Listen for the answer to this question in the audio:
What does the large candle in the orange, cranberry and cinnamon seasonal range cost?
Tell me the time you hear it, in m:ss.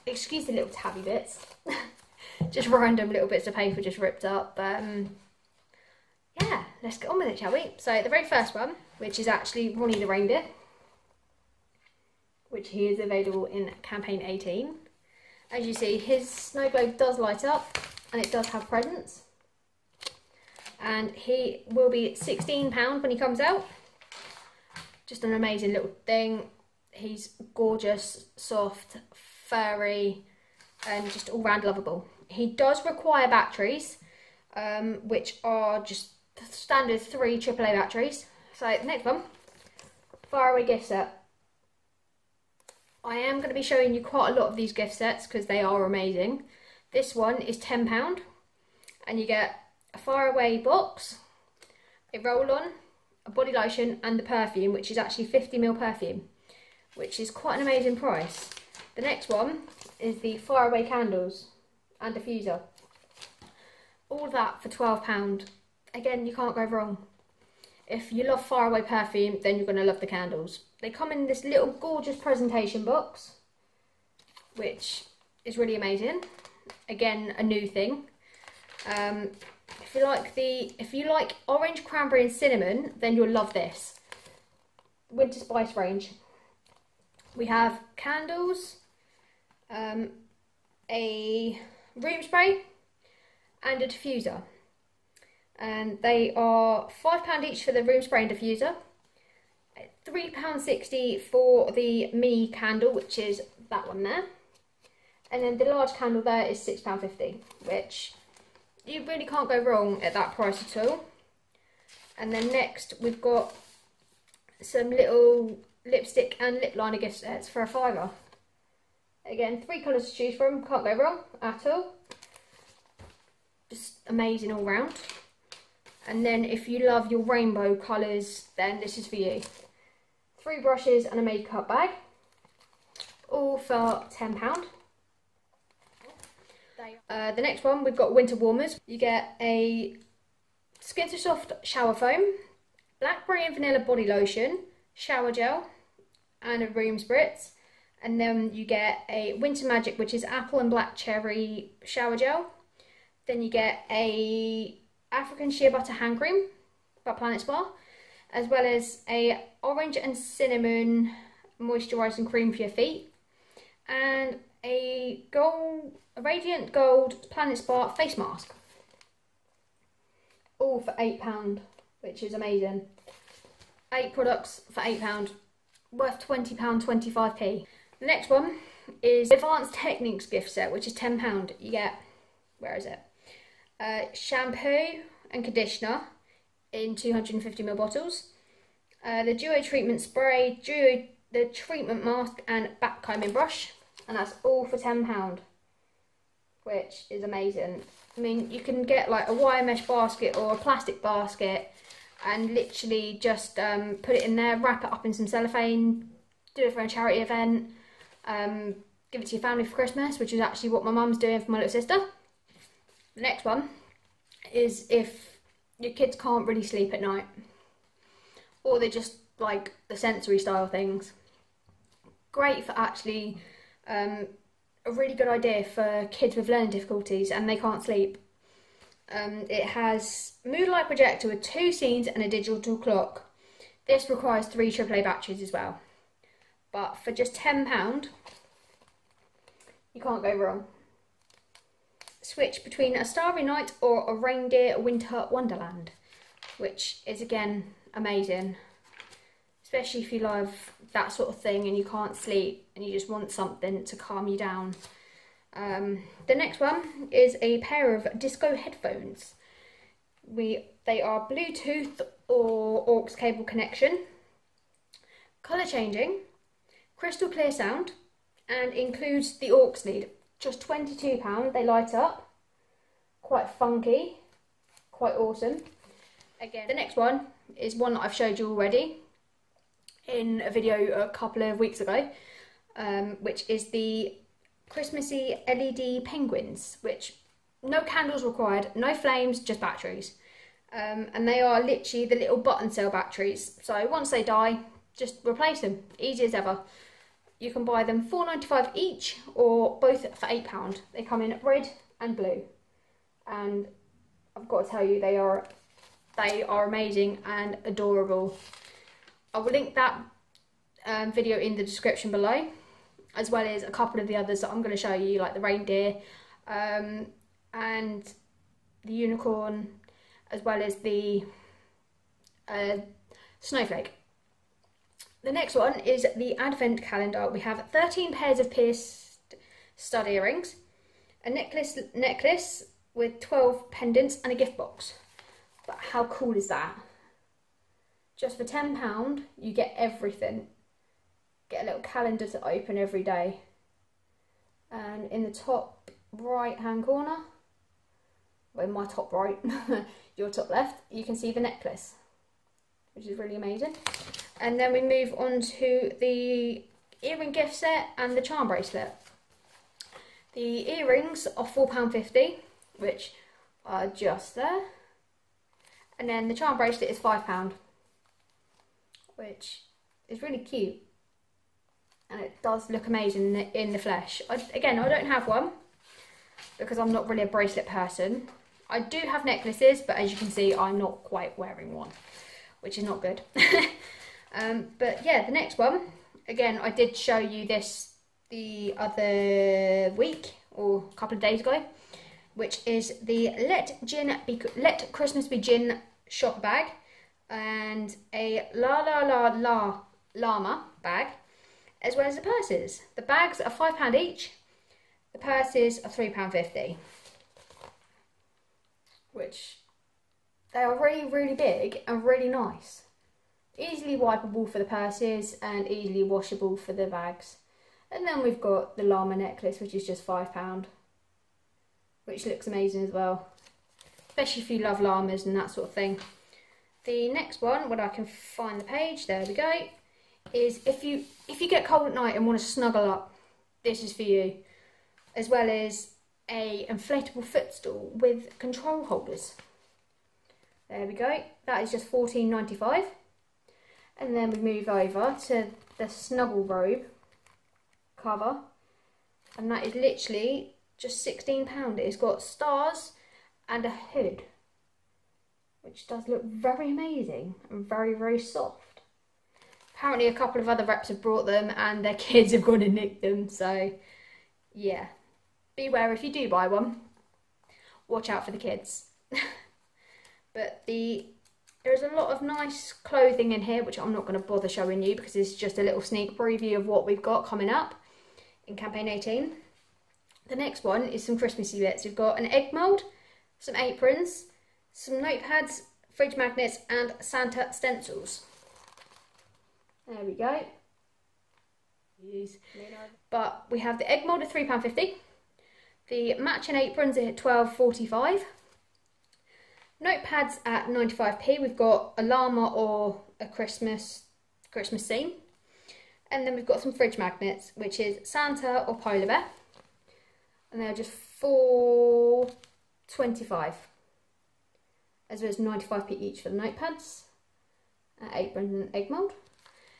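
1:46.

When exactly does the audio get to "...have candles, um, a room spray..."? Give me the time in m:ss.
1:27.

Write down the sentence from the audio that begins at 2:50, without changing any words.
All for eight pound, which is amazing.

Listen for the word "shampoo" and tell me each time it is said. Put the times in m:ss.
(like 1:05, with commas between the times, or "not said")
3:04.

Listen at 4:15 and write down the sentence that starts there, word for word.
Um, the next one is a pair of disco headphones.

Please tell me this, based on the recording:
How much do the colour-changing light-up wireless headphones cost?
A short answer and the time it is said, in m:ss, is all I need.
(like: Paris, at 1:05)
£22, at 4:30.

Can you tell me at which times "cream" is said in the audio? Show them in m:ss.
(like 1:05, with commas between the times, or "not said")
2:36, 2:42.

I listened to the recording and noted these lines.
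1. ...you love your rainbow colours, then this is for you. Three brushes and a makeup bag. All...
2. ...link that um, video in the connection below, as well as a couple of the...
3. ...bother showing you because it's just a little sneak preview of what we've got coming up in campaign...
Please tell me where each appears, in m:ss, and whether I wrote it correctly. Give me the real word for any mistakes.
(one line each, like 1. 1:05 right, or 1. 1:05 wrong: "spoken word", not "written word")
1. 2:06 right
2. 5:09 wrong: "description", not "connection"
3. 7:54 right.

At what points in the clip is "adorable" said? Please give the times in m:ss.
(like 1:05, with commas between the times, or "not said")
5:07.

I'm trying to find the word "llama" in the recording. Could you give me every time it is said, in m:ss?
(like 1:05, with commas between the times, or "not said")
6:40, 6:58, 7:04, 8:22.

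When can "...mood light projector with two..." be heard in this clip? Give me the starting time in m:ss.
3:50.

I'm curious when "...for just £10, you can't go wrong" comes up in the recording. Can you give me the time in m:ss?
3:56.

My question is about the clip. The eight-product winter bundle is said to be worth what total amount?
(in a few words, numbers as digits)
£20.25.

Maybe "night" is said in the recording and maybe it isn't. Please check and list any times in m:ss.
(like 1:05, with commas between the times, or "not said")
3:37, 4:03, 7:11.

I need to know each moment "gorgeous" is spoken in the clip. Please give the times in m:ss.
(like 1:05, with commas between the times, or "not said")
0:27, 1:11.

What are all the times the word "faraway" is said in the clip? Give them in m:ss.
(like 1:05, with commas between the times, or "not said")
0:40, 0:49, 1:00, 1:08.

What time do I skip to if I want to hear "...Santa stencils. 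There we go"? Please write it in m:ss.
8:07.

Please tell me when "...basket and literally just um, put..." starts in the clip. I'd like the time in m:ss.
3:21.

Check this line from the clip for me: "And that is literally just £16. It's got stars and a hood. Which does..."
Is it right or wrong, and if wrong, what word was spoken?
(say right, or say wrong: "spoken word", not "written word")
right.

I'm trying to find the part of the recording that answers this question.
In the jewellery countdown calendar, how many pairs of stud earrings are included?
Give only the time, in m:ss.
5:27.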